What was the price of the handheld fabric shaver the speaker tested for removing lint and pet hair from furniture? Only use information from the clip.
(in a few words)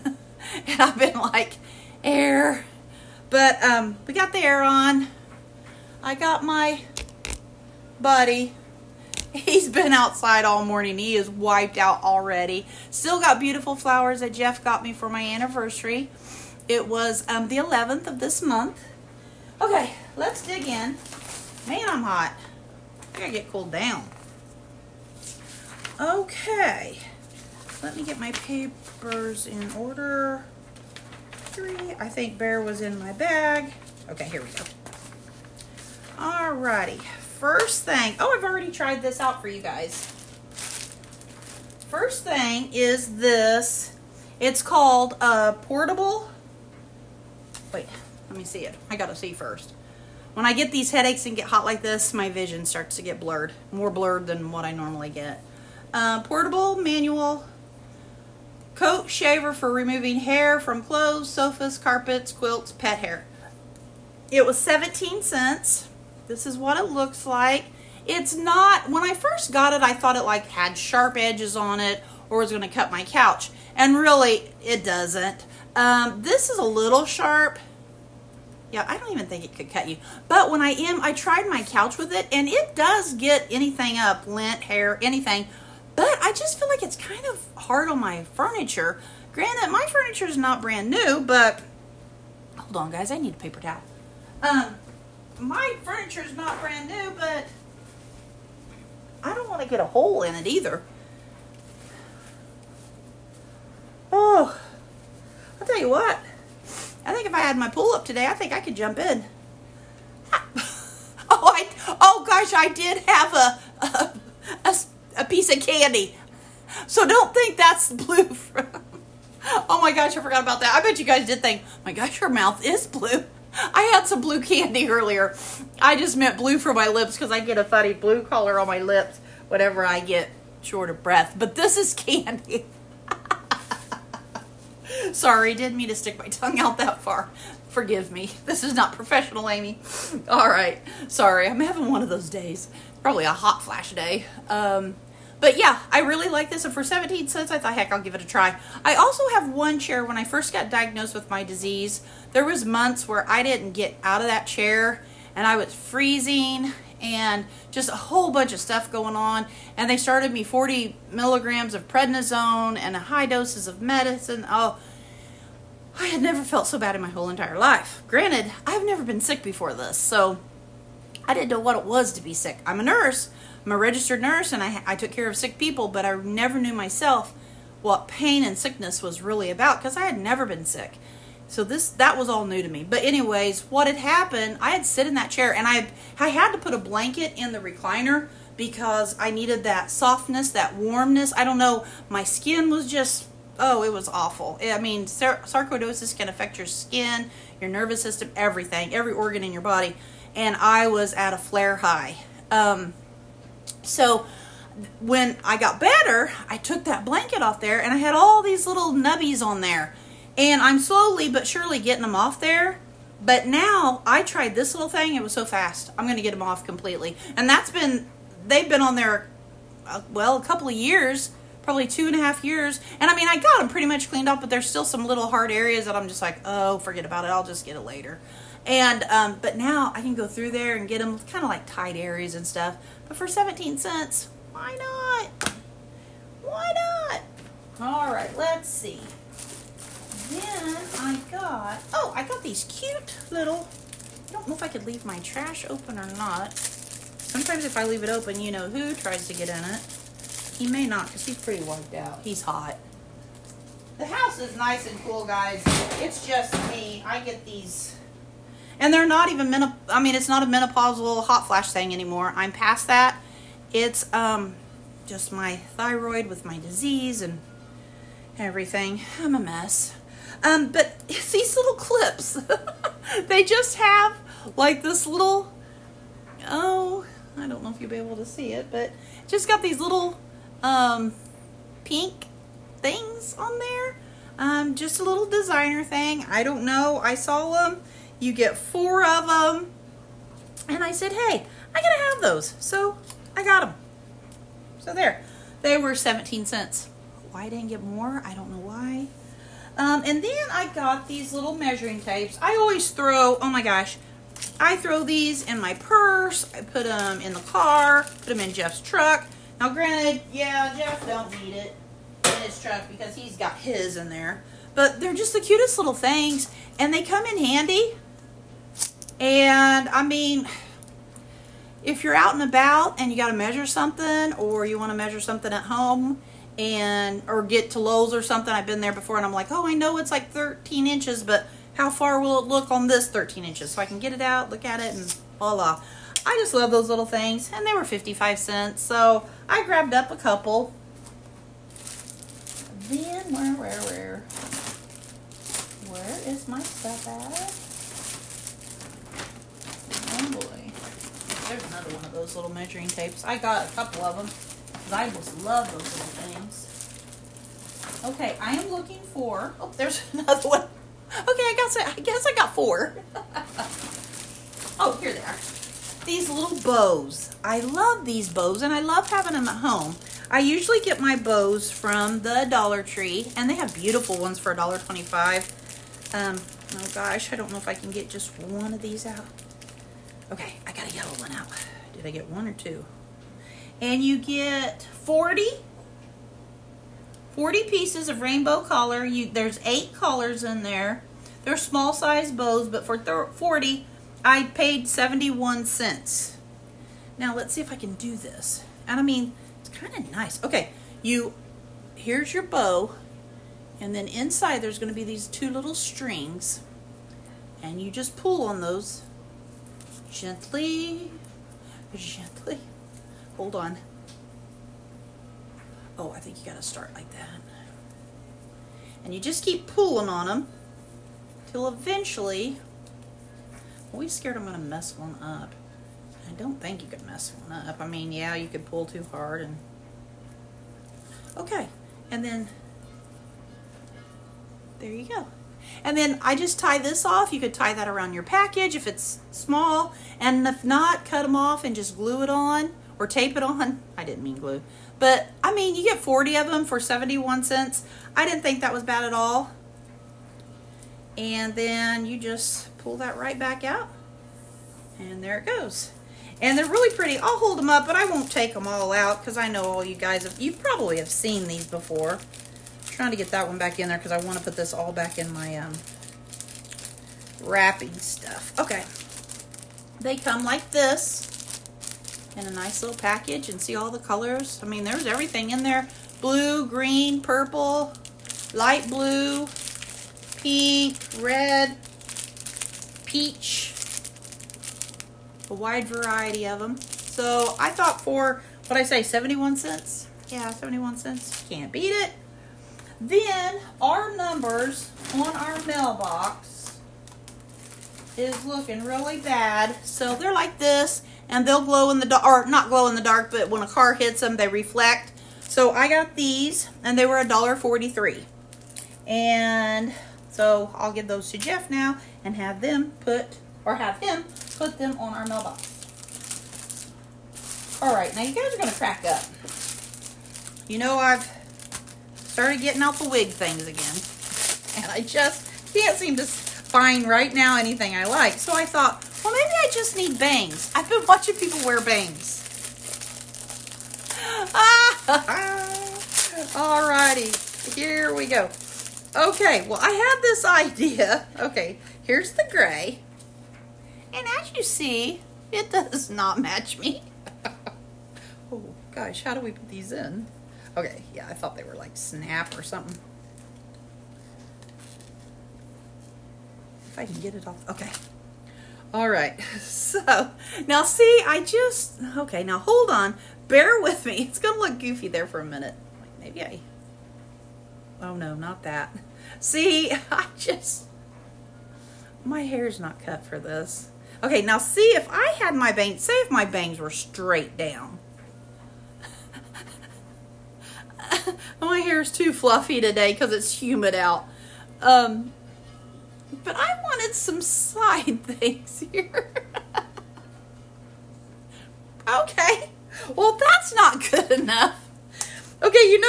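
17 cents.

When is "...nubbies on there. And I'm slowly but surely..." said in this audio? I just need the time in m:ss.
3:28.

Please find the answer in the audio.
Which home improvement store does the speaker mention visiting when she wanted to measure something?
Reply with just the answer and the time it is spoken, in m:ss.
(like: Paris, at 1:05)
Lowe's, at 5:27.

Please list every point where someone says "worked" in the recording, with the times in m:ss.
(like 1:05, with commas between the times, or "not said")
not said.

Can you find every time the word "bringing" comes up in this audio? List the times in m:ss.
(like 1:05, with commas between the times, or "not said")
not said.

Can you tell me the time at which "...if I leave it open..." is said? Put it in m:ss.
4:07.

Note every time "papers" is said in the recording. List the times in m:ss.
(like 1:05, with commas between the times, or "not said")
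0:28, 1:33.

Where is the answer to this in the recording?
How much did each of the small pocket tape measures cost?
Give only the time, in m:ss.
5:37.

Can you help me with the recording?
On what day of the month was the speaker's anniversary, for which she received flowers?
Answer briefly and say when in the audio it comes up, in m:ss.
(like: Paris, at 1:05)
11th, at 0:17.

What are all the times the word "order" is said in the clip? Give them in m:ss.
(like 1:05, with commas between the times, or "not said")
0:29.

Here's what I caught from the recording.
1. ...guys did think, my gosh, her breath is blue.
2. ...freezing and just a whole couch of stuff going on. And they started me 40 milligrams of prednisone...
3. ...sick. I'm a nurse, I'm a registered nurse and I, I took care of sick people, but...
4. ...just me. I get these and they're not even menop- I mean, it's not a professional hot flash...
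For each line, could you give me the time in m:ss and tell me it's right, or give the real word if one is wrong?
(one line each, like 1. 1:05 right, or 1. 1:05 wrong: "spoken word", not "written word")
1. 2:01 wrong: "mouth", not "breath"
2. 2:35 wrong: "bunch", not "couch"
3. 2:52 right
4. 4:16 wrong: "menopausal", not "professional".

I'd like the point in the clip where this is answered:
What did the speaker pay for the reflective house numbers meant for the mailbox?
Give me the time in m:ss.
8:27.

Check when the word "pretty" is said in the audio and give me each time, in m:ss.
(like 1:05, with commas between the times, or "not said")
3:43, 4:11, 7:36.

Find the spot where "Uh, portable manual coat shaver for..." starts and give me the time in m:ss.
0:55.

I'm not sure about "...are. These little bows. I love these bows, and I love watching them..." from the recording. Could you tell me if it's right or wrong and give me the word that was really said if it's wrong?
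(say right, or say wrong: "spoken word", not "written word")
wrong: "having", not "watching".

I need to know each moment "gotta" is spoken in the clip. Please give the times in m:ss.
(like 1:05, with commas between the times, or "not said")
0:23, 0:48, 6:56.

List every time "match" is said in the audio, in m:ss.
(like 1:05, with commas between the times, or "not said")
9:06.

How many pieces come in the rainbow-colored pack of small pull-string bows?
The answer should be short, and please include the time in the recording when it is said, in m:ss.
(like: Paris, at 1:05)
40, at 6:27.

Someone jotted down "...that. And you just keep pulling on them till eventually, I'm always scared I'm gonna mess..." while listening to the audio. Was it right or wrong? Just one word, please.
right.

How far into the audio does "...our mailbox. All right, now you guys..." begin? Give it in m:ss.
8:35.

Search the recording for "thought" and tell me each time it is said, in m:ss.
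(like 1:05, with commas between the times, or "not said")
1:09, 2:27, 8:07, 8:48, 9:11.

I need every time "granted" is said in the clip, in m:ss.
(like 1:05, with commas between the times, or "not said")
1:29, 2:48, 5:09.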